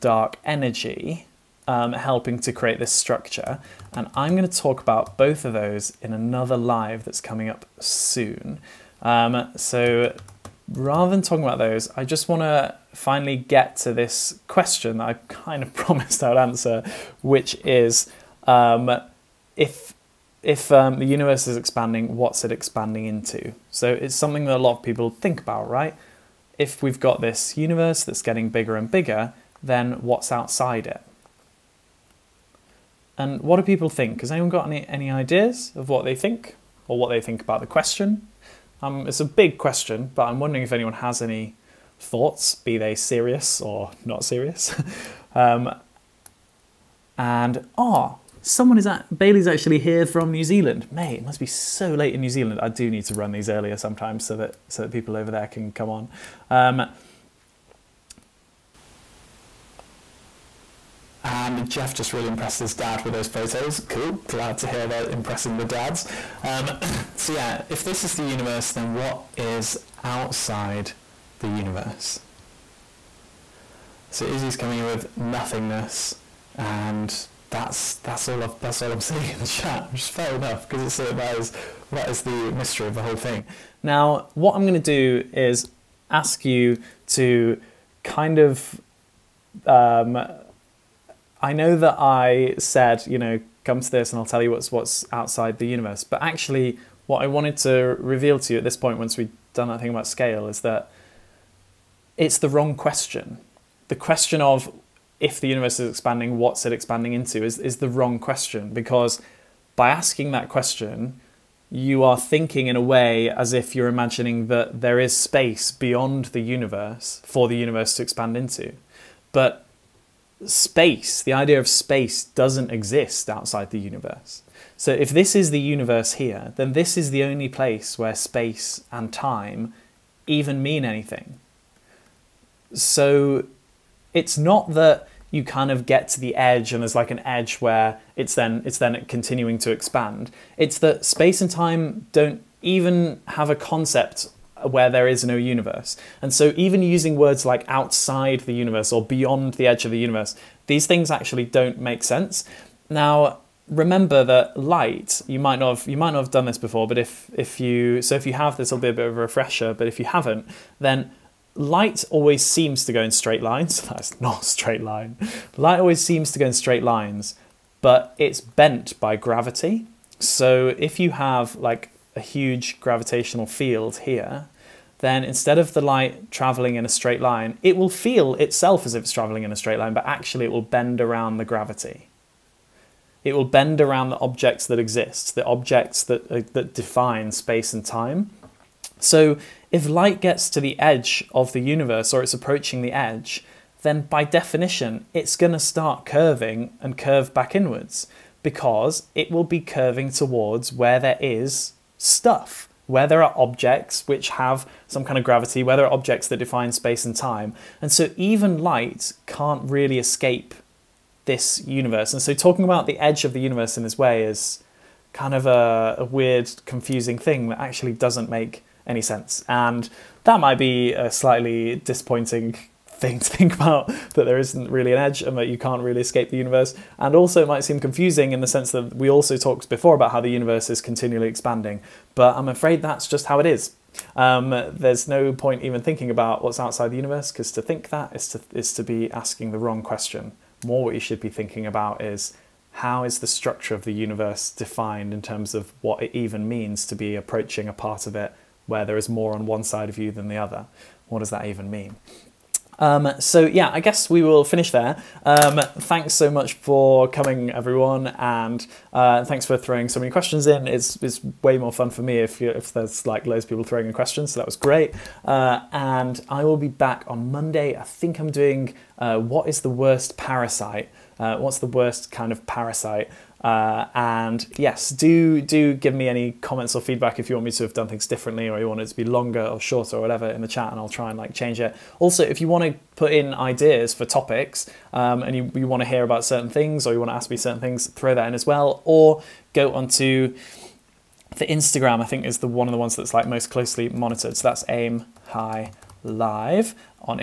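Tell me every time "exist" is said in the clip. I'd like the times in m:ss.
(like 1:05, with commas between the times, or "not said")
2:02, 3:04.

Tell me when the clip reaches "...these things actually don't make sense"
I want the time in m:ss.
2:30.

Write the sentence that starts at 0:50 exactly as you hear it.
Mate, it must be so late in New Zealand.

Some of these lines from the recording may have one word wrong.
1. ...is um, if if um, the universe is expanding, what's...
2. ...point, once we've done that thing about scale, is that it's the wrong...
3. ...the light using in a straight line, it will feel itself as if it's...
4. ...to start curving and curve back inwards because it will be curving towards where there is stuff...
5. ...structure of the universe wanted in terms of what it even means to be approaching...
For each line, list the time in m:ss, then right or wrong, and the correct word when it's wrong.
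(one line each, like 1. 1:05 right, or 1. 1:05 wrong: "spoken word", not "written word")
1. 0:17 right
2. 1:38 right
3. 2:55 wrong: "traveling", not "using"
4. 3:15 right
5. 4:03 wrong: "defined", not "wanted".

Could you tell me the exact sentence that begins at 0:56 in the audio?
Um, and Jeff just really impressed his dad with those photos.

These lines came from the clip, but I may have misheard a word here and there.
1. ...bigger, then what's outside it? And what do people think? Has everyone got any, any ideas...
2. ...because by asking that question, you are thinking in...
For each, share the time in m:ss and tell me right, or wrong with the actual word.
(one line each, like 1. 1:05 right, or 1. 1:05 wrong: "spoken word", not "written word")
1. 0:28 wrong: "anyone", not "everyone"
2. 1:48 right.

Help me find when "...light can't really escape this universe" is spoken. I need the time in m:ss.
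3:28.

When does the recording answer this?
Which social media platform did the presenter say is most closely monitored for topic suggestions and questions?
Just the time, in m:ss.
4:51.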